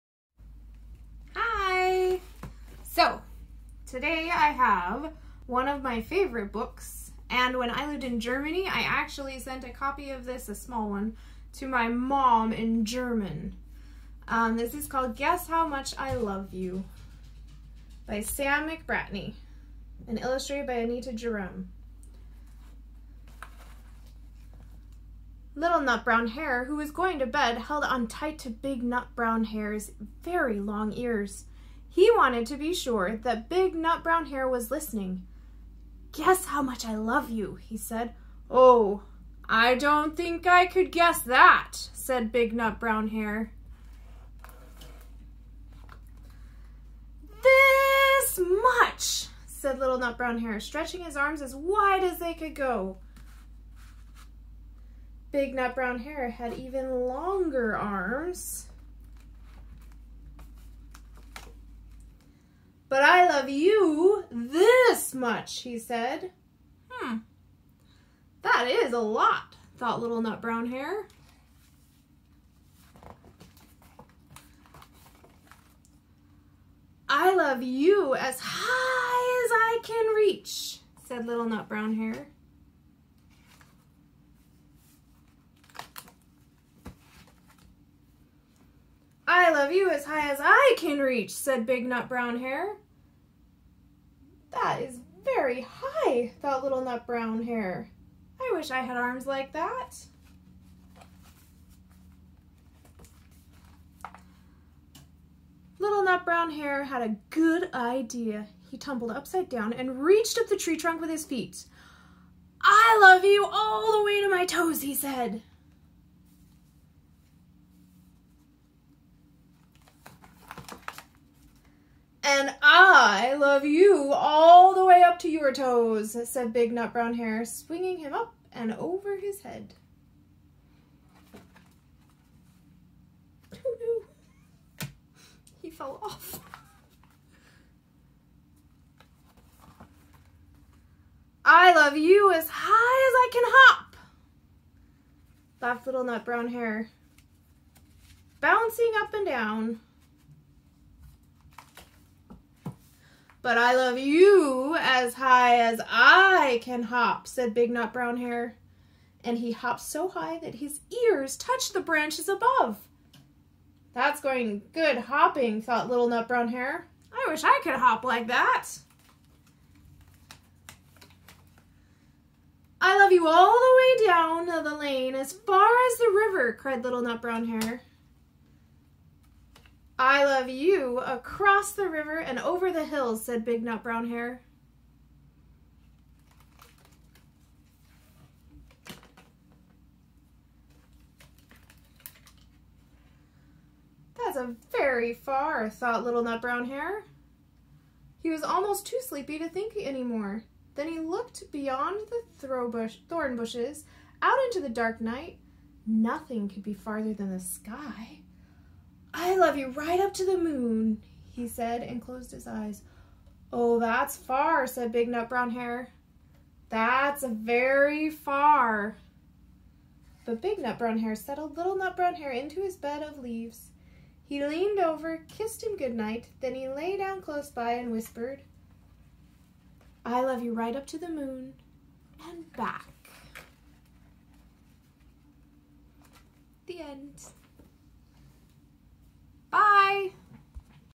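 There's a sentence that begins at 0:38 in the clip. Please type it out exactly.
Oh, I don't think I could guess that, said big nut brown hare.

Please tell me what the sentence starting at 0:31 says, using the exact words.
He wanted to be sure that big nut brown hare was listening.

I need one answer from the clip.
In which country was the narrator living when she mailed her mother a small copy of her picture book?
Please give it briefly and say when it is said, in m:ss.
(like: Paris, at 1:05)
Germany, at 0:08.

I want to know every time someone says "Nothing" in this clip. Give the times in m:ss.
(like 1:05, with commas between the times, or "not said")
3:25.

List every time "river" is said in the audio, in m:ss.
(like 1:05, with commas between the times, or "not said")
2:56, 3:01.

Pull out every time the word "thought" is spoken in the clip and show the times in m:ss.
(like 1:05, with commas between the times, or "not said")
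1:09, 1:36, 2:45, 3:15.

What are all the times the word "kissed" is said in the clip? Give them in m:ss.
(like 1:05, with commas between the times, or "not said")
3:45.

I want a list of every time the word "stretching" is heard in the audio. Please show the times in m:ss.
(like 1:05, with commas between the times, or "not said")
0:50.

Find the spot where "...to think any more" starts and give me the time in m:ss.
3:19.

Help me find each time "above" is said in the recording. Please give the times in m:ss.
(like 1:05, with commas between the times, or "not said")
2:42.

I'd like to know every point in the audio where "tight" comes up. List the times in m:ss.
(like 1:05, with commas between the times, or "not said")
0:28.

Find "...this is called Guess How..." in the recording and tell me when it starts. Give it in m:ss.
0:14.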